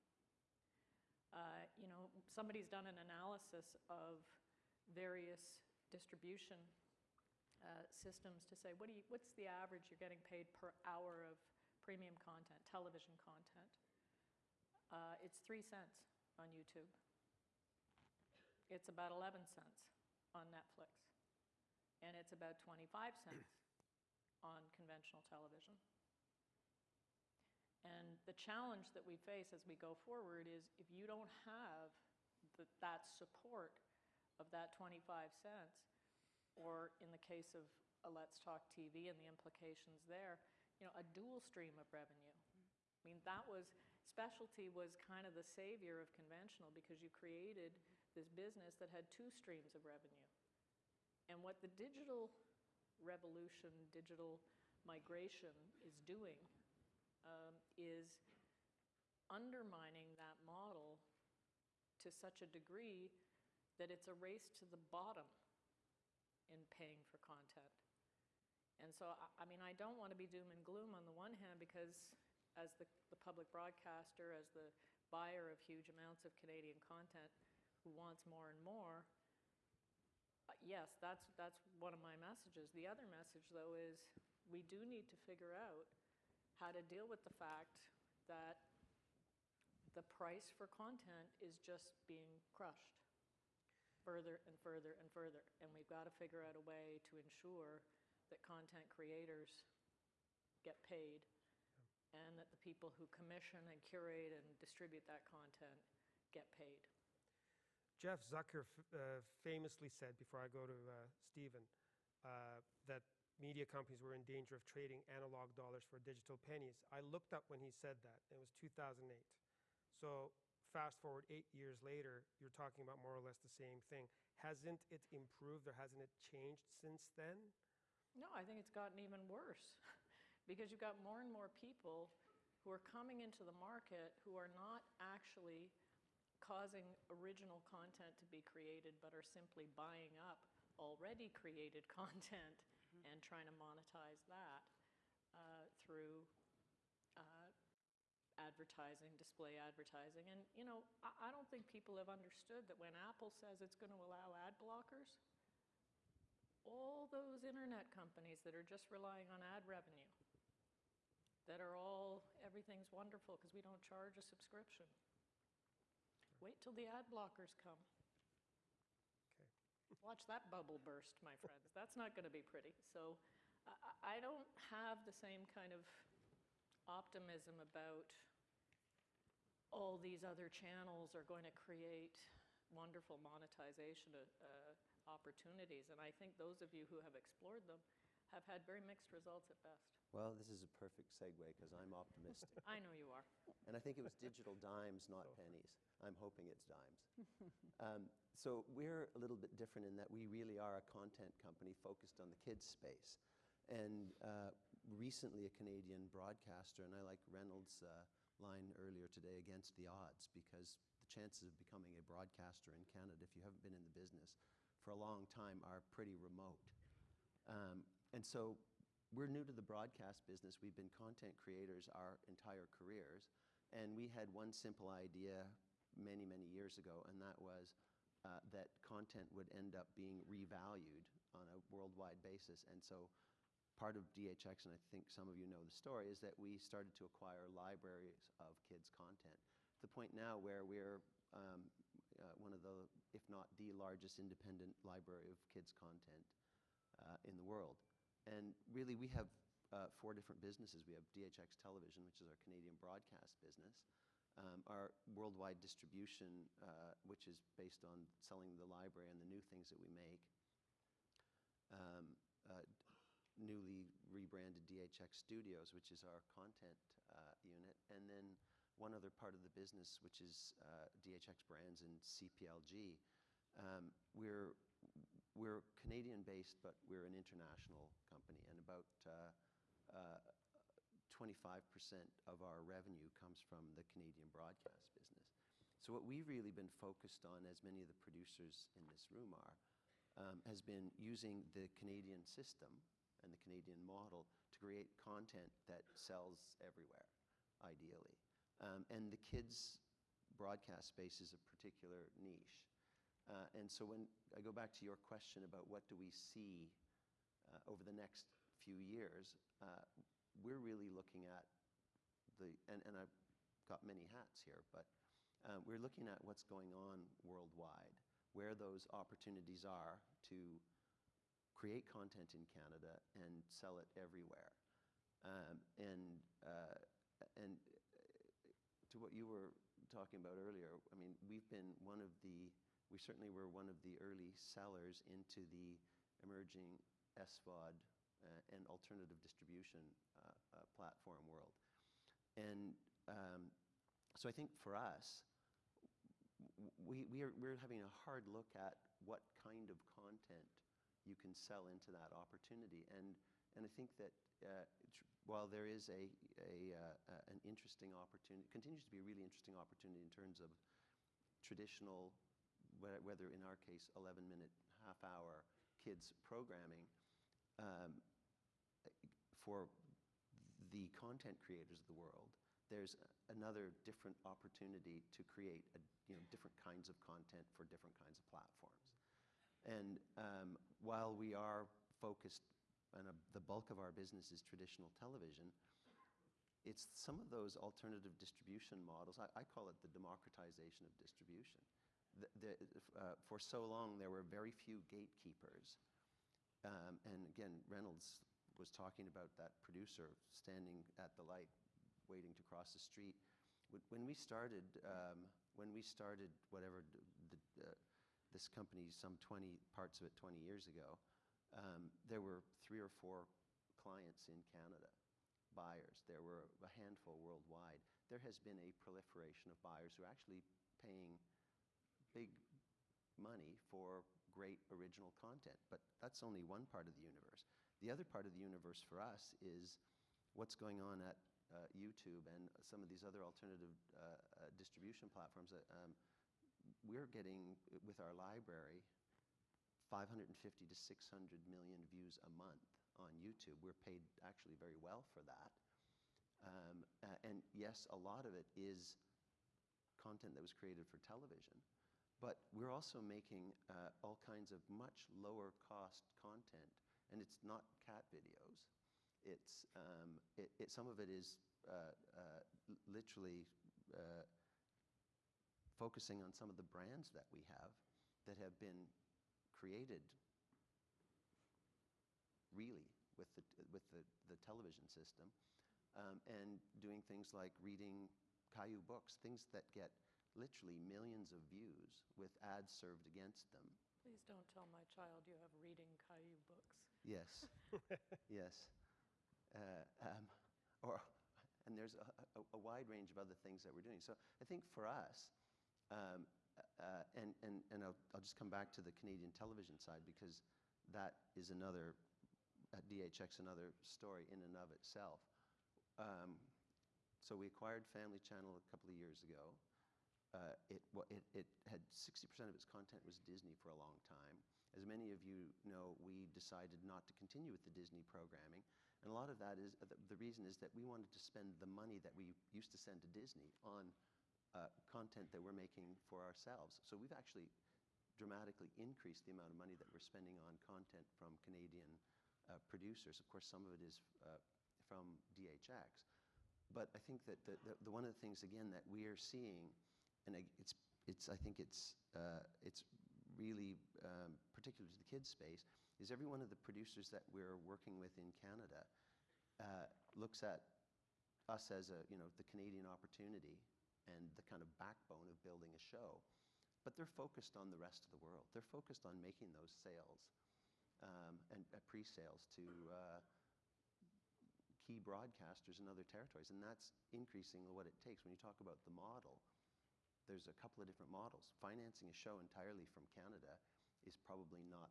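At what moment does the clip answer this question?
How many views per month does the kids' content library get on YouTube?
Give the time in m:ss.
7:19.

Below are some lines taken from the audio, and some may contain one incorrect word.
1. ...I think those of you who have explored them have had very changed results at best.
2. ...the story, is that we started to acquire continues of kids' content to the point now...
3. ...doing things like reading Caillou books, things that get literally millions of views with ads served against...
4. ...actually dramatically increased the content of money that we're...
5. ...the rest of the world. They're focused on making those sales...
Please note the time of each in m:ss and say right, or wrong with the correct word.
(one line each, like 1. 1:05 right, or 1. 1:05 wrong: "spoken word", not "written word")
1. 3:06 wrong: "mixed", not "changed"
2. 3:55 wrong: "libraries", not "continues"
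3. 7:56 right
4. 8:47 wrong: "amount", not "content"
5. 9:17 right.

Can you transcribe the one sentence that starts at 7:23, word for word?
We're paid actually very well for that.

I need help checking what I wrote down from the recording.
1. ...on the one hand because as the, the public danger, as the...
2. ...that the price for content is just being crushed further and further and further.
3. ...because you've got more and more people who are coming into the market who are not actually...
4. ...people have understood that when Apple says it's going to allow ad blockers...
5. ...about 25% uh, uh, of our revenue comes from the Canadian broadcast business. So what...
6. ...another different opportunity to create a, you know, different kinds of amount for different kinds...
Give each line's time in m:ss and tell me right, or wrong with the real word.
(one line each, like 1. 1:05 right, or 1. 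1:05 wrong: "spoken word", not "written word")
1. 1:10 wrong: "broadcaster", not "danger"
2. 1:28 right
3. 2:10 right
4. 2:31 right
5. 4:38 right
6. 6:13 wrong: "content", not "amount".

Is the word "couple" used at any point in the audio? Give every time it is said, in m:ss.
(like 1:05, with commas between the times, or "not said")
8:28, 9:30.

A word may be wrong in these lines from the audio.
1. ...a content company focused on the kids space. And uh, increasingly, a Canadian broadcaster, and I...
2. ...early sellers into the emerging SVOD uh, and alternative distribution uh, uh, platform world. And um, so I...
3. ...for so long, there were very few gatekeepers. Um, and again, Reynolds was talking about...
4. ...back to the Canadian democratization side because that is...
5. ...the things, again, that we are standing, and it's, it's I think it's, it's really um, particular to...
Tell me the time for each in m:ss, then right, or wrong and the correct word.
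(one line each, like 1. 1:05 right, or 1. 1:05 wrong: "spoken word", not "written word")
1. 3:20 wrong: "recently", not "increasingly"
2. 5:34 right
3. 6:33 right
4. 8:18 wrong: "television", not "democratization"
5. 8:58 wrong: "seeing", not "standing".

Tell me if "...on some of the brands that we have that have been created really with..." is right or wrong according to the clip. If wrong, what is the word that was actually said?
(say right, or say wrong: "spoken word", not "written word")
right.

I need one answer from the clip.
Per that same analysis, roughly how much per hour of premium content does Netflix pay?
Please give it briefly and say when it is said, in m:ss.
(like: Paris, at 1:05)
11 cents, at 0:19.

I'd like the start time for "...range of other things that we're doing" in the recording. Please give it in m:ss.
8:12.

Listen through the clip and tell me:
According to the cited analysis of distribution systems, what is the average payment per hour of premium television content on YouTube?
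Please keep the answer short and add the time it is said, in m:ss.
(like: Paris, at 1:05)
3 cents, at 0:15.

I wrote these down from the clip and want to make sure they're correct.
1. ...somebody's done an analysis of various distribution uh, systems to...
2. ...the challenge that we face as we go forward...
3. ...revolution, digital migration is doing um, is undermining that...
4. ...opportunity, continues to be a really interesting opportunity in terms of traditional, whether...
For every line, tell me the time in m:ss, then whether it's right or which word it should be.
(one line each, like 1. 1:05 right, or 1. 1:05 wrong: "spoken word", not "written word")
1. 0:02 right
2. 0:28 right
3. 0:52 right
4. 5:57 right.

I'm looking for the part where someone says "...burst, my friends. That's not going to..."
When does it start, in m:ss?
2:50.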